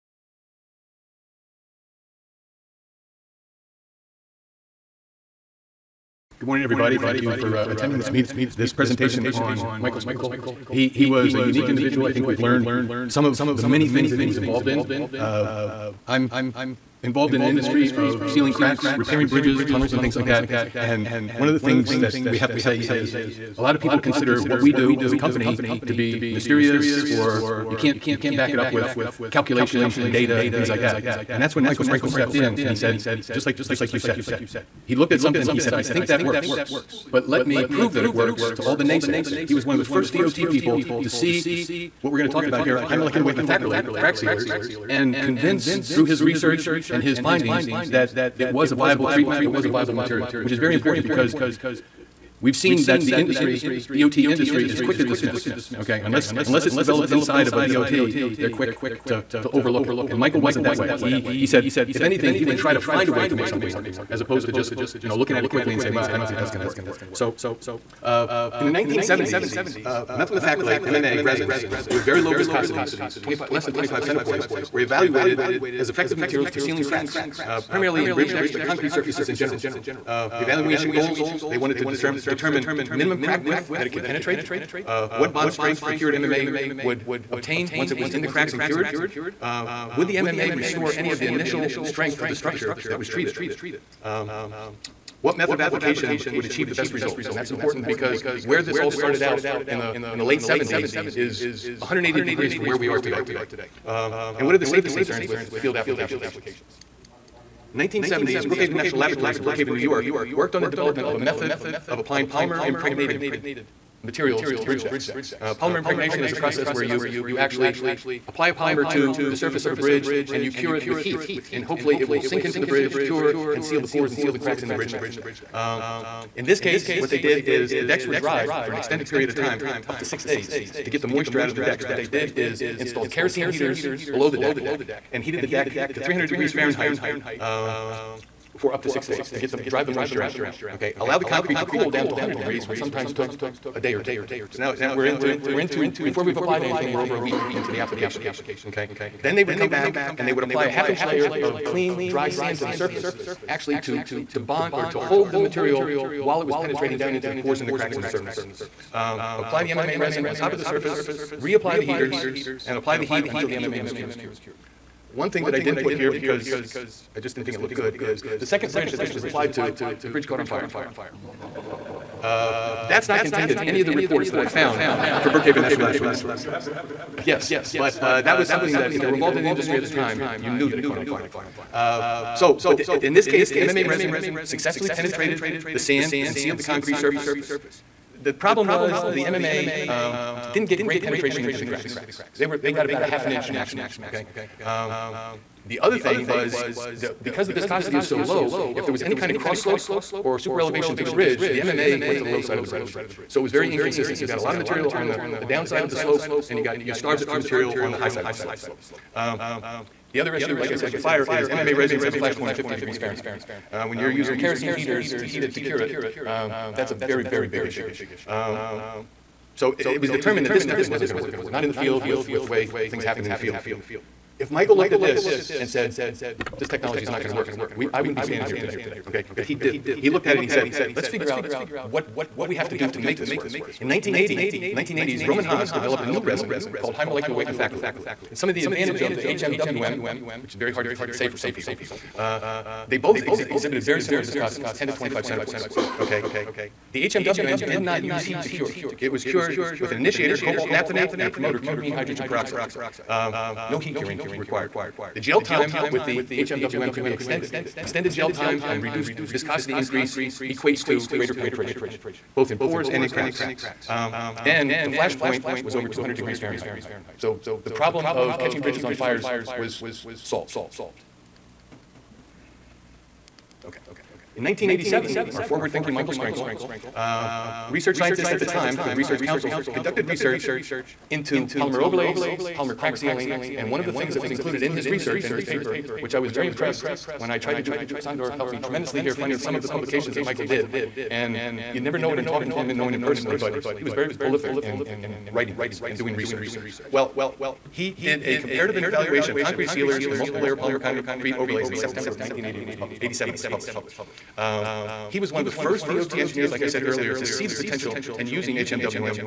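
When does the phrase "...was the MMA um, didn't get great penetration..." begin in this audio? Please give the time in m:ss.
3:08.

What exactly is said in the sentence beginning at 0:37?
But let me prove that it works to all the naysayers.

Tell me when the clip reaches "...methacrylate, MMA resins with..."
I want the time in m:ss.
1:10.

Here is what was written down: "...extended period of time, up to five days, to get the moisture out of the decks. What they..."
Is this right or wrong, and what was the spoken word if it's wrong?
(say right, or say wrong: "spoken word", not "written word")
wrong: "six", not "five".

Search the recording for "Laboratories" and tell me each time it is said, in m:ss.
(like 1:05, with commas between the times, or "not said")
1:48, 2:55.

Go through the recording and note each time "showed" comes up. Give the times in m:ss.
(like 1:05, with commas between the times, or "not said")
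not said.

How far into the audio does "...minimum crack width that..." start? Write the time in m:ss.
1:22.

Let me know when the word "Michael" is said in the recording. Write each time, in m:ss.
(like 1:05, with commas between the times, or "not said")
0:09, 0:31, 1:00, 3:44, 4:35, 4:50.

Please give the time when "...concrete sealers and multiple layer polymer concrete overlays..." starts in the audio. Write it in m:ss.
4:59.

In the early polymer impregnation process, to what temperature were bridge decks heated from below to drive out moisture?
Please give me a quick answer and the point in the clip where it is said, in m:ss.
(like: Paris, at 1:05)
300 degrees Fahrenheit, at 2:16.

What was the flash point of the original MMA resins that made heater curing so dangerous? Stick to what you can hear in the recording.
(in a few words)
50 degrees Fahrenheit.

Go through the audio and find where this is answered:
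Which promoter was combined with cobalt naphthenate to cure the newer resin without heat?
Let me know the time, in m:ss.
4:11.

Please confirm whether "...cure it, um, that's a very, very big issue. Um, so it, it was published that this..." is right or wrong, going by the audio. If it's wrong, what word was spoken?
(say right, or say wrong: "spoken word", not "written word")
wrong: "determined", not "published".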